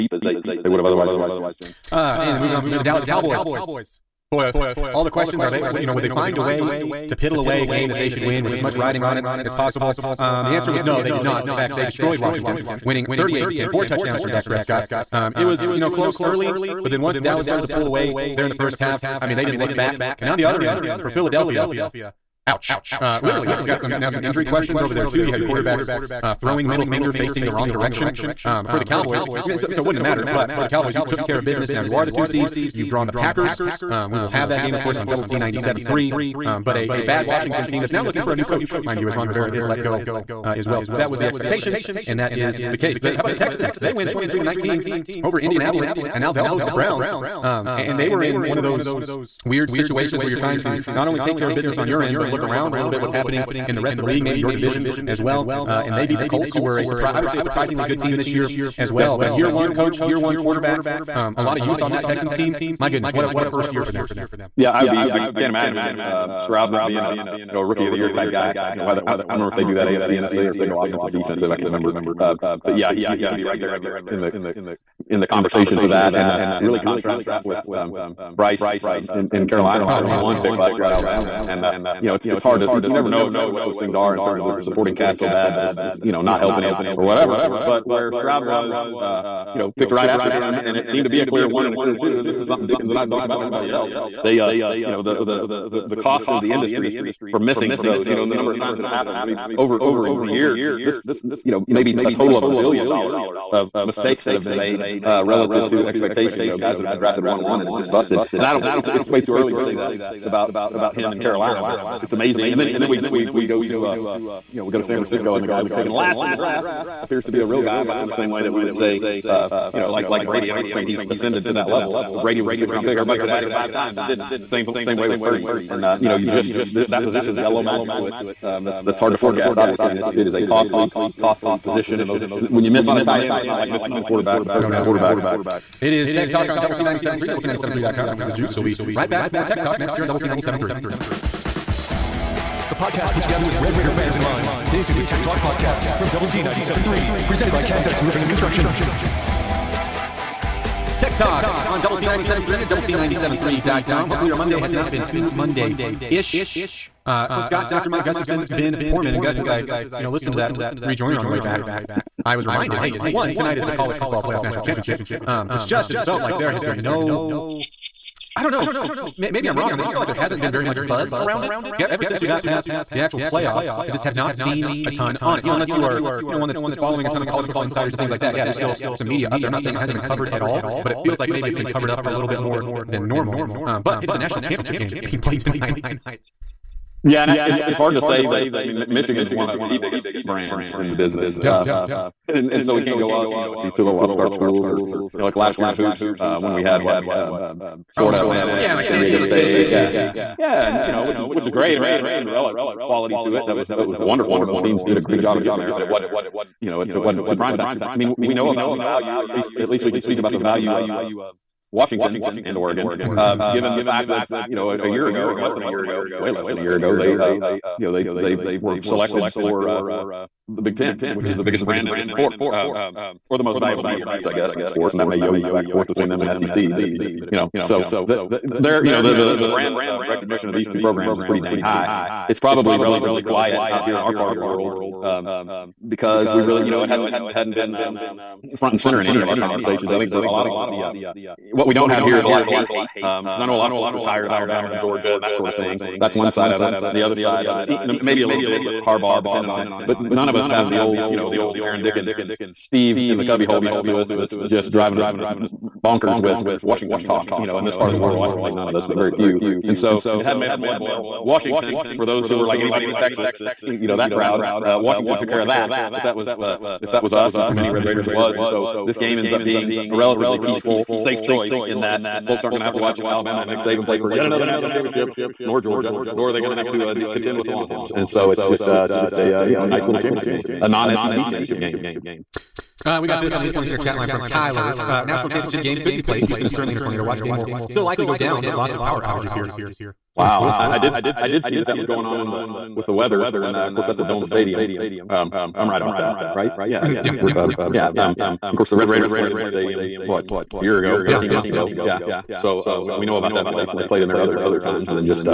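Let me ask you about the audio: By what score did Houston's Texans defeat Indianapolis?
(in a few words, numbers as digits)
23 to 19.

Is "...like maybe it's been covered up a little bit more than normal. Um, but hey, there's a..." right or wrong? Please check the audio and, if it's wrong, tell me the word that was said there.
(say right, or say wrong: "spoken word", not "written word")
right.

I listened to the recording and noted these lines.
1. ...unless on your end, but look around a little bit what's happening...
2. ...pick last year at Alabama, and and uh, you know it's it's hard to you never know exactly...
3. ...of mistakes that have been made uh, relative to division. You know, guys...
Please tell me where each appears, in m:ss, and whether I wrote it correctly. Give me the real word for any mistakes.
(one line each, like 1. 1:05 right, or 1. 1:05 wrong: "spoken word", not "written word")
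1. 0:51 wrong: "business", not "unless"
2. 1:20 right
3. 1:43 wrong: "expectation", not "division".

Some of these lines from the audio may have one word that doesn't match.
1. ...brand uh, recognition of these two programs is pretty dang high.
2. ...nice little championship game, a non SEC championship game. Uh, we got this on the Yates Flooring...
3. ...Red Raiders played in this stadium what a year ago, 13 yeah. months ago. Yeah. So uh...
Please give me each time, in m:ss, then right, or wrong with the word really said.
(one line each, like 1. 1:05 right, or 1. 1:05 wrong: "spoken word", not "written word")
1. 3:49 right
2. 4:39 right
3. 4:58 right.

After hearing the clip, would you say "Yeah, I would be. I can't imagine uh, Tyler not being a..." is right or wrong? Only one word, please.
wrong.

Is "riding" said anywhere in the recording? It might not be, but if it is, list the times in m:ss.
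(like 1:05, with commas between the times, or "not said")
0:08.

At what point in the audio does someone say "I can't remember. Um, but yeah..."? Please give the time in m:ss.
1:11.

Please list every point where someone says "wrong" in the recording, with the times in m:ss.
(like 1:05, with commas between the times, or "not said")
0:27, 2:49.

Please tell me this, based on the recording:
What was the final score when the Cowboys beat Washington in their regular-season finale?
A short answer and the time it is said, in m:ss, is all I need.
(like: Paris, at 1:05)
38 to 10, at 0:13.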